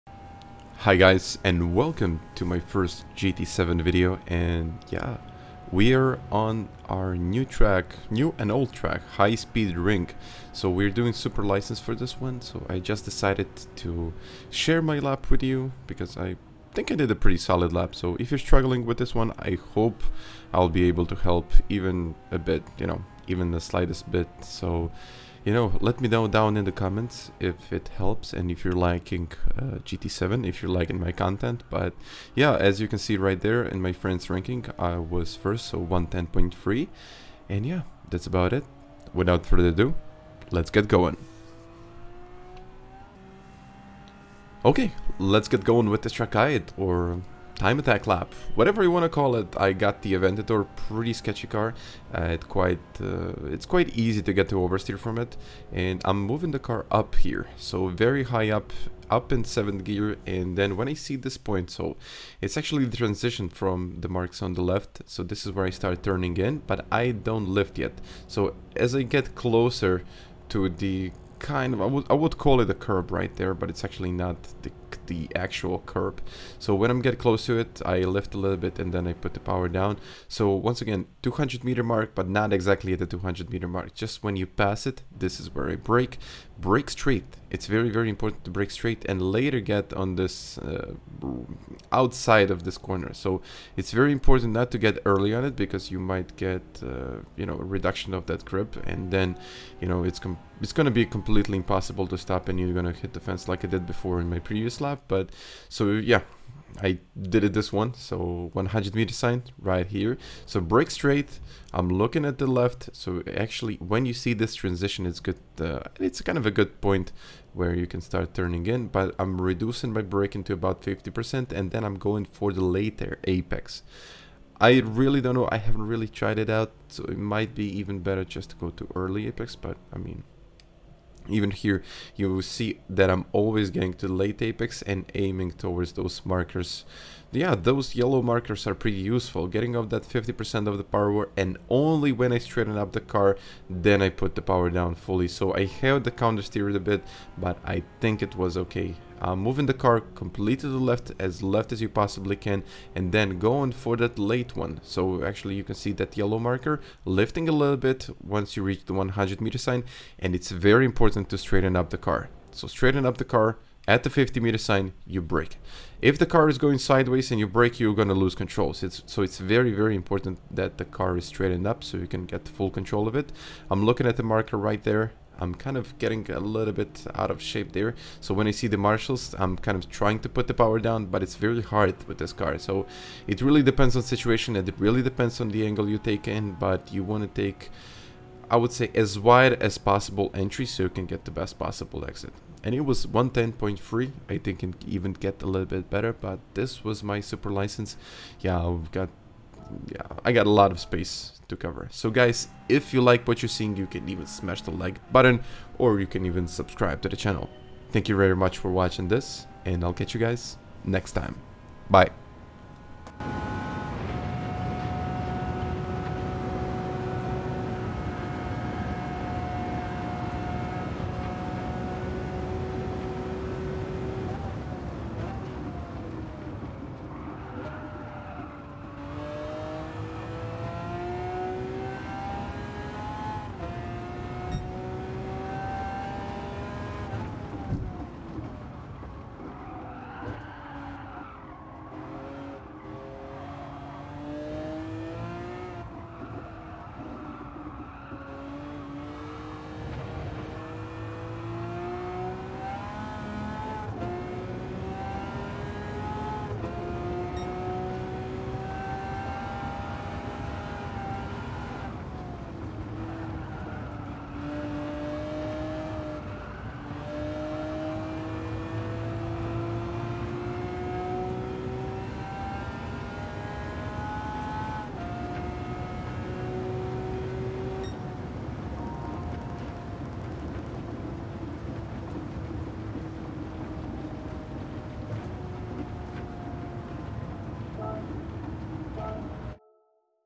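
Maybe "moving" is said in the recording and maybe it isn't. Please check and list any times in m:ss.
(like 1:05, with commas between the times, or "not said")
0:56, 2:29.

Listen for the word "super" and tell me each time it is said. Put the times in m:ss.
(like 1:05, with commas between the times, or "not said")
0:11, 3:17.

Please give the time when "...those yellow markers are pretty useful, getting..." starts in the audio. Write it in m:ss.
2:17.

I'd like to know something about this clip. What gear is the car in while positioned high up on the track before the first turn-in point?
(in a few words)
7th gear.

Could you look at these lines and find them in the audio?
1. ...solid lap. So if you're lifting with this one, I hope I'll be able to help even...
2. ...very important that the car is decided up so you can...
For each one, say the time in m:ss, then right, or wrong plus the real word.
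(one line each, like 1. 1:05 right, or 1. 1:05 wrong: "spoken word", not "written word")
1. 0:17 wrong: "struggling", not "lifting"
2. 2:49 wrong: "straightened", not "decided".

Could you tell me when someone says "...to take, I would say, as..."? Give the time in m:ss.
3:07.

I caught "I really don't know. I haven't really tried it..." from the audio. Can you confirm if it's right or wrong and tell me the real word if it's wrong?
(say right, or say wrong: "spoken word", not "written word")
right.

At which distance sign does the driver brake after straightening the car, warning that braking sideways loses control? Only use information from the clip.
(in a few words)
50 meter sign.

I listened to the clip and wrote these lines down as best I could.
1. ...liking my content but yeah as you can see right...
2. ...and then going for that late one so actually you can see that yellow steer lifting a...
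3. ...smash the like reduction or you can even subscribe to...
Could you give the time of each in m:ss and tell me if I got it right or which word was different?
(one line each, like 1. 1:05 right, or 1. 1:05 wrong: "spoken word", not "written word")
1. 0:30 right
2. 2:32 wrong: "marker", not "steer"
3. 3:24 wrong: "button", not "reduction".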